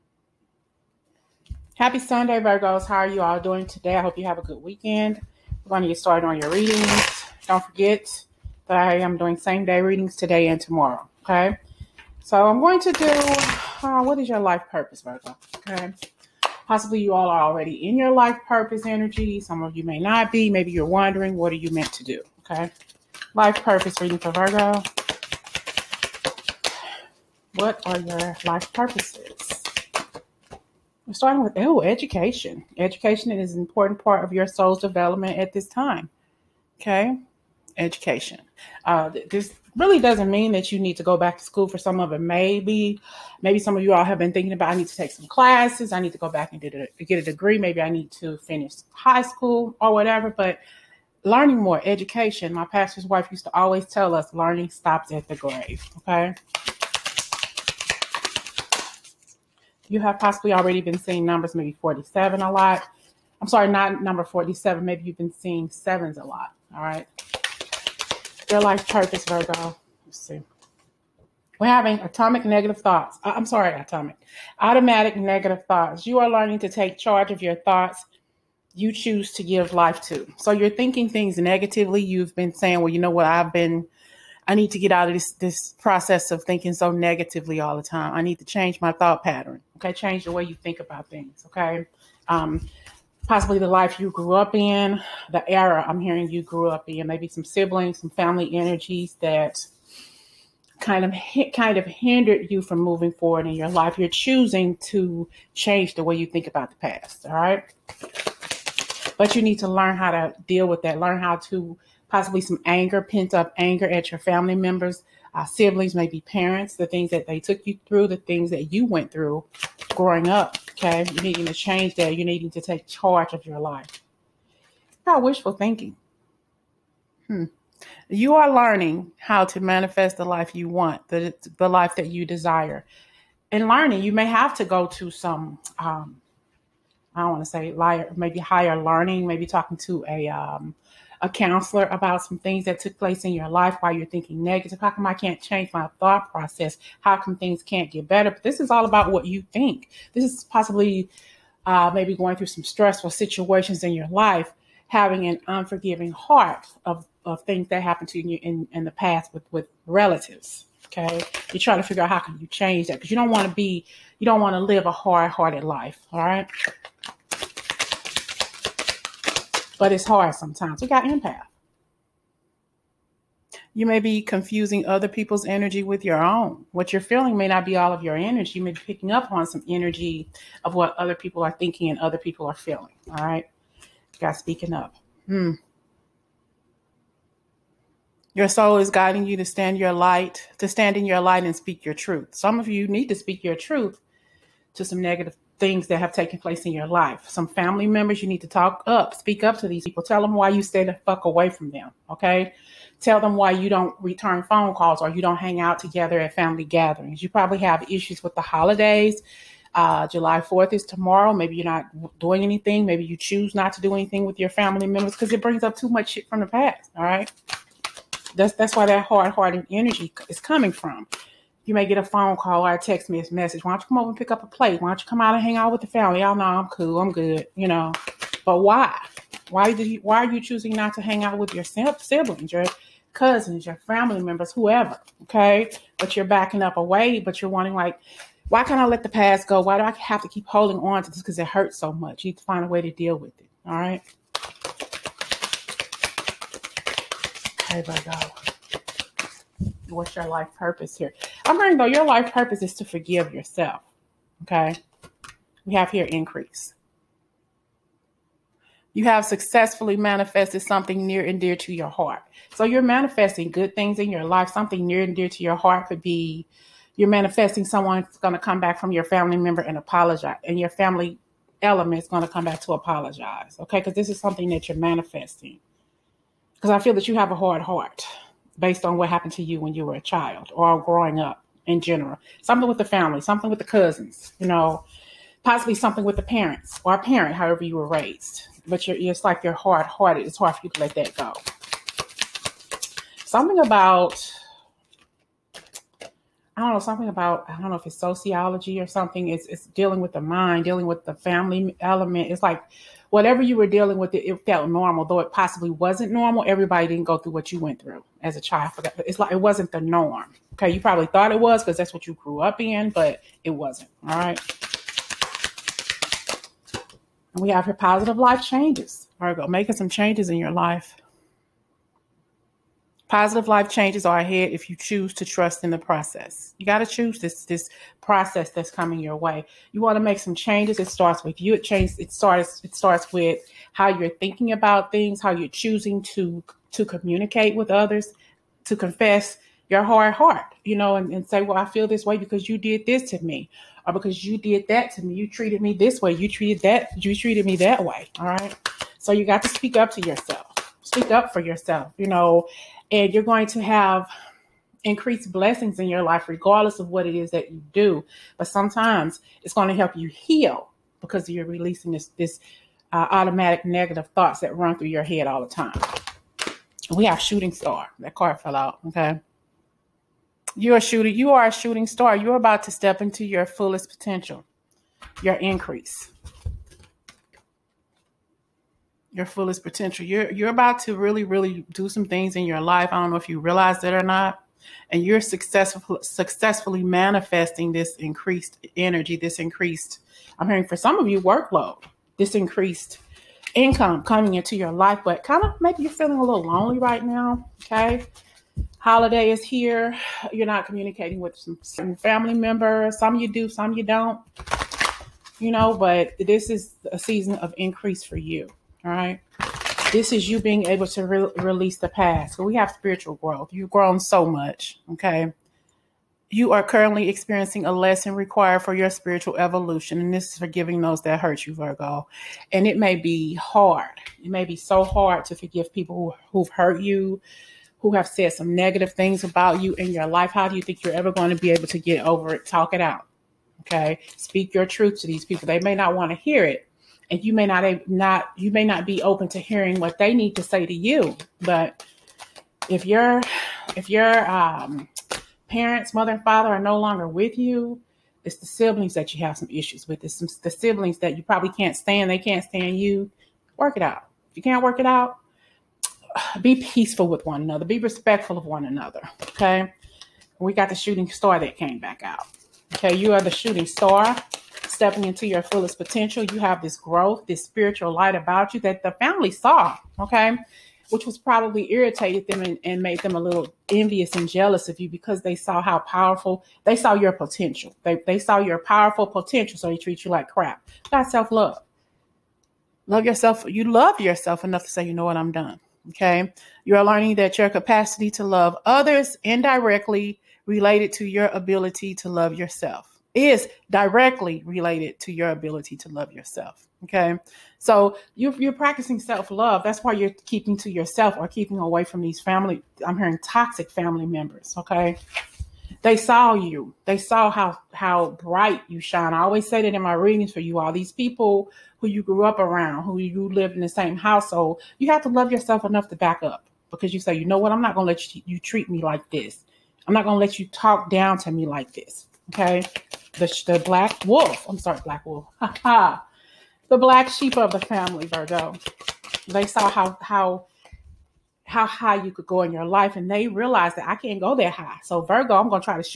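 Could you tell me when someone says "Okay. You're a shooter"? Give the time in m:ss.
6:08.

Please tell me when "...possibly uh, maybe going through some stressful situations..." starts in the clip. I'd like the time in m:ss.
2:30.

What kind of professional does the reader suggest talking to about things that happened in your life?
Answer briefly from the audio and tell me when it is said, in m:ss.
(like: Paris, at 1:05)
A counselor, at 2:21.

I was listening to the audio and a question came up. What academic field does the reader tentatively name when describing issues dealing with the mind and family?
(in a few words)
Sociology.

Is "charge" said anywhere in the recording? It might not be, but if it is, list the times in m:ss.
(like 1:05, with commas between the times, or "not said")
1:16, 2:02.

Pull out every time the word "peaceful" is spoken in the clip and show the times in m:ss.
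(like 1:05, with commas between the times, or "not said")
7:36.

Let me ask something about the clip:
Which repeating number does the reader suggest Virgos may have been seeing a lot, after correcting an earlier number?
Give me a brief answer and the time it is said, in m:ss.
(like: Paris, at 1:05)
7, at 1:05.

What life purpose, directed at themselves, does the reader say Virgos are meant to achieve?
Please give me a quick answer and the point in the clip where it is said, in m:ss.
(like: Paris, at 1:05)
Forgive yourself, at 4:12.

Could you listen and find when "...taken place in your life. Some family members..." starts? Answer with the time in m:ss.
3:16.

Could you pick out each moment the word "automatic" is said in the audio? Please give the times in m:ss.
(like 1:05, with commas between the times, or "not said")
1:14, 6:03.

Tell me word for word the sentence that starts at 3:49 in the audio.
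Why did you, why are you choosing not to hang out with your siblings, your cousins, your family members, whoever?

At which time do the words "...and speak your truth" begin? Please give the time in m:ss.
3:11.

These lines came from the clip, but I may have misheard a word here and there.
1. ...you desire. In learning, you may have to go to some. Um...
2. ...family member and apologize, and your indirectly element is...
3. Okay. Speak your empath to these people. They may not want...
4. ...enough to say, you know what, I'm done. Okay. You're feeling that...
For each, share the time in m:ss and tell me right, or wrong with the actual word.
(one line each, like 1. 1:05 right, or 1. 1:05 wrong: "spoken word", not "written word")
1. 2:12 right
2. 4:29 wrong: "family", not "indirectly"
3. 7:13 wrong: "truth", not "empath"
4. 8:04 wrong: "learning", not "feeling".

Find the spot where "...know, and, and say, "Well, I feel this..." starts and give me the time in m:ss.
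5:40.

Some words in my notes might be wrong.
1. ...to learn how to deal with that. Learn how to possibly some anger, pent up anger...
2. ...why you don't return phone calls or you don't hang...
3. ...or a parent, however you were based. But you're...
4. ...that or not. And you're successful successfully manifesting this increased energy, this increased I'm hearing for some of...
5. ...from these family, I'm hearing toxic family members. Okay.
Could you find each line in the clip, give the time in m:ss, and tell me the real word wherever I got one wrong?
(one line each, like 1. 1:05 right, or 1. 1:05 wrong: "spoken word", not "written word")
1. 1:49 right
2. 3:23 right
3. 4:46 wrong: "raised", not "based"
4. 6:23 right
5. 8:21 right.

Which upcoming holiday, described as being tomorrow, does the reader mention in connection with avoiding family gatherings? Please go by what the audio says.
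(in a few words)
July 4th.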